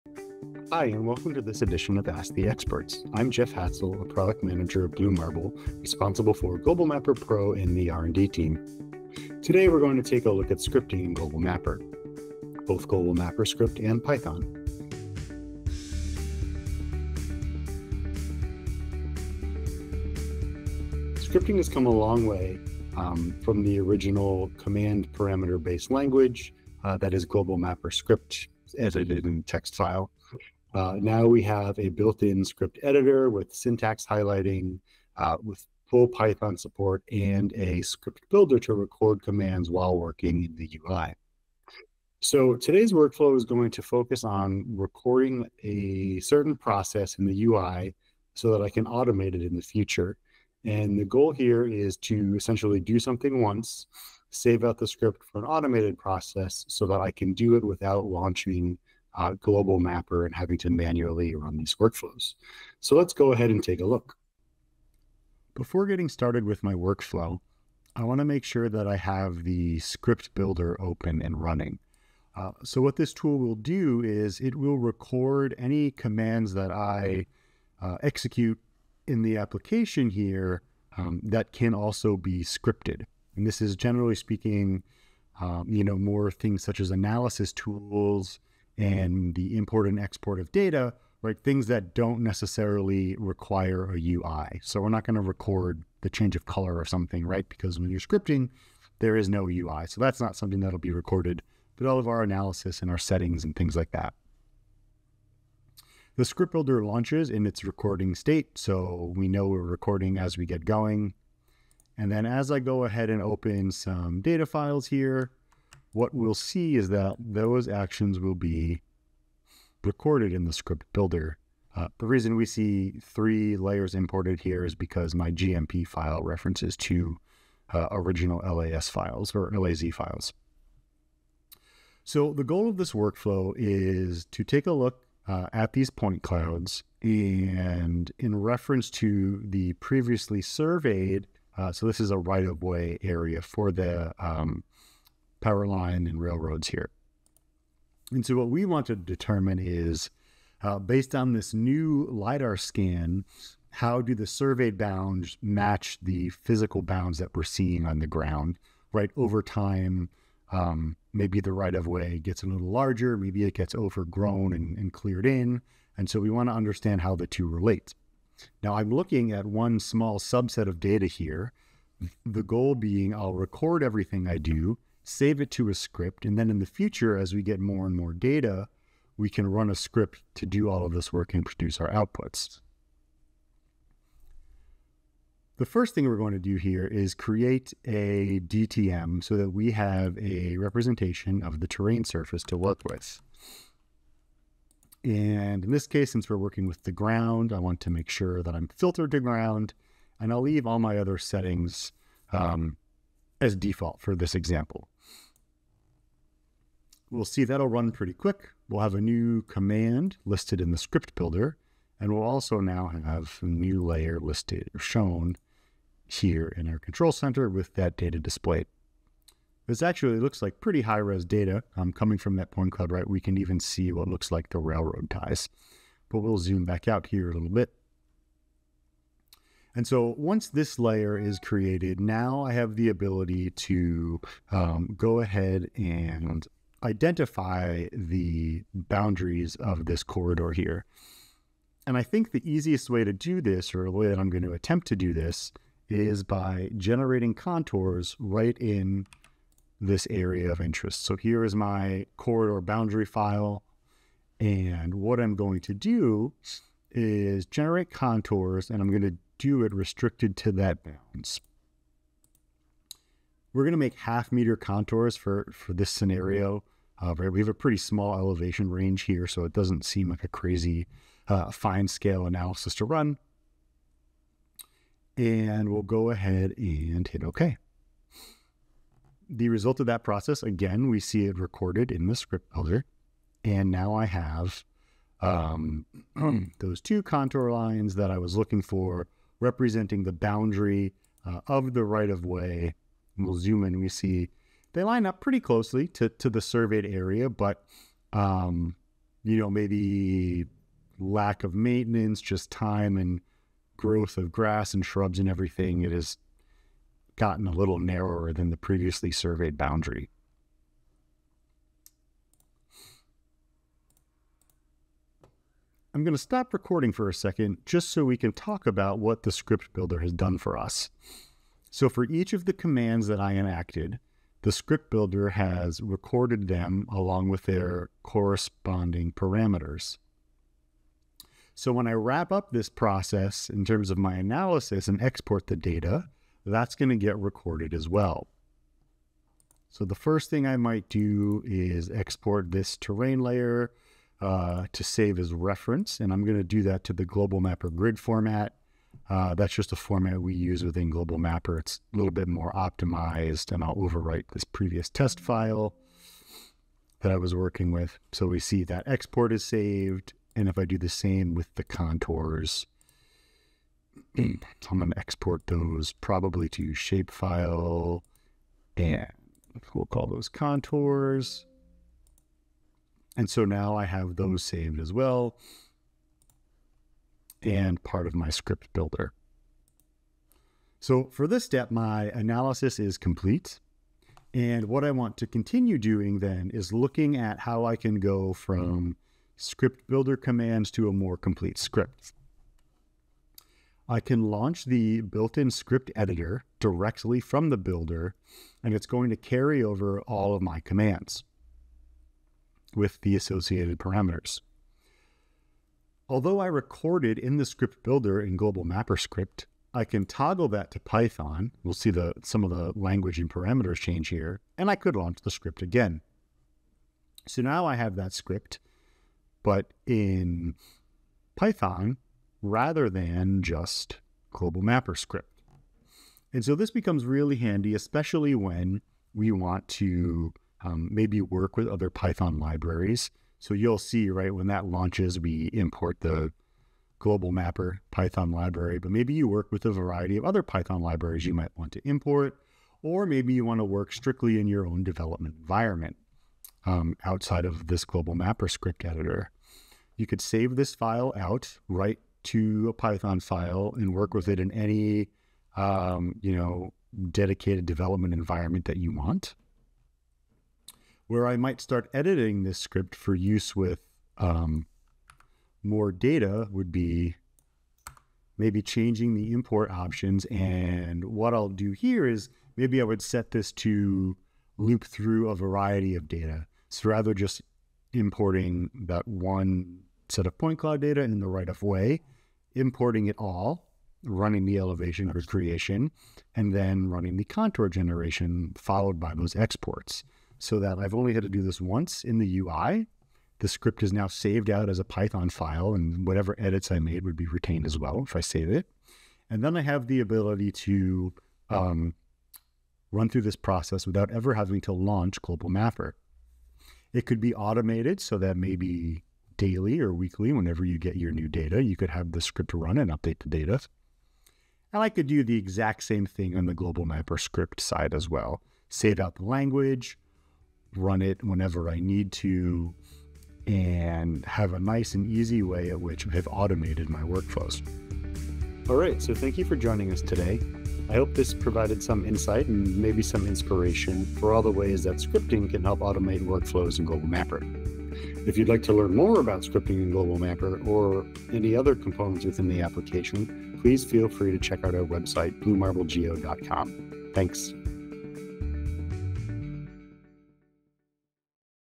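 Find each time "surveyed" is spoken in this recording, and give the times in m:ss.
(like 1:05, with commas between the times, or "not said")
2:20, 2:34, 4:56, 5:09.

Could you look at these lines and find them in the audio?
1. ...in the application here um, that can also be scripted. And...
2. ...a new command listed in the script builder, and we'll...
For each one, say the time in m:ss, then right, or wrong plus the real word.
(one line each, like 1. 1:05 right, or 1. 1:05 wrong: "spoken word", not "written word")
1. 1:19 right
2. 3:28 right.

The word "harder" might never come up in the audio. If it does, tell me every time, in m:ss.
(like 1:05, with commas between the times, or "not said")
not said.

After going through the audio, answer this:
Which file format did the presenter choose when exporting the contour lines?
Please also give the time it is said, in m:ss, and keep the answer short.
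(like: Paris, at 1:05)
shapefile, at 6:06.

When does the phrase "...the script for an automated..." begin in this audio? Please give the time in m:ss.
0:54.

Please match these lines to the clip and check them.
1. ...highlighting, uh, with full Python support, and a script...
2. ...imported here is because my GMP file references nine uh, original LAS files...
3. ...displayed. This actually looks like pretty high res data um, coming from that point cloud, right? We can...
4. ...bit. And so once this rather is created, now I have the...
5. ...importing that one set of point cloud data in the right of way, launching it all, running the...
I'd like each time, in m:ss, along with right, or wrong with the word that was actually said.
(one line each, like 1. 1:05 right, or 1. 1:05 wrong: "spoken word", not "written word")
1. 0:34 right
2. 2:03 wrong: "two", not "nine"
3. 3:38 right
4. 3:47 wrong: "layer", not "rather"
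5. 7:57 wrong: "importing", not "launching".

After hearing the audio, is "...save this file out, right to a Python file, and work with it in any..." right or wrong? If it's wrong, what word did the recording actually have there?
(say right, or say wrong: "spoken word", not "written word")
right.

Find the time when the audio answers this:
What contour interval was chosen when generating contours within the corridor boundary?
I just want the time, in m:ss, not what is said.
4:23.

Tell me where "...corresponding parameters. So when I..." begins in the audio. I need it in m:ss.
5:28.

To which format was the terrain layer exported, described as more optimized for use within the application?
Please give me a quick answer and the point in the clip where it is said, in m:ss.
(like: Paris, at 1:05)
Global Mapper grid, at 5:47.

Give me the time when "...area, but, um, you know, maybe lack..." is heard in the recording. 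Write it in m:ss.
4:56.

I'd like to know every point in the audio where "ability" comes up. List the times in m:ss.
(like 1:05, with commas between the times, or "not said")
3:52, 8:19.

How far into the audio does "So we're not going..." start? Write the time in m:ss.
1:34.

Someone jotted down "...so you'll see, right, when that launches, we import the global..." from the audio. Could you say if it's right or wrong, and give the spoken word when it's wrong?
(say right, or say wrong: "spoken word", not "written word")
right.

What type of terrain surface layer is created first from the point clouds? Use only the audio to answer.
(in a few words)
DTM.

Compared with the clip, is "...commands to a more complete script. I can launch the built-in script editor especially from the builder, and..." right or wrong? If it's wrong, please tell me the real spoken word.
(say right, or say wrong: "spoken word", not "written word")
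wrong: "directly", not "especially".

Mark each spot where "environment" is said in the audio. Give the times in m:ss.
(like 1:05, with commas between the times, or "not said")
7:25, 7:38.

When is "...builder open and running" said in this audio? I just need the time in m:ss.
1:10.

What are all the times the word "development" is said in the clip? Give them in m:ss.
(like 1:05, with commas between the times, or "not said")
7:24, 7:37.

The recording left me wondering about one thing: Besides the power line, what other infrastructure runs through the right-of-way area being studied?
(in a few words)
railroads.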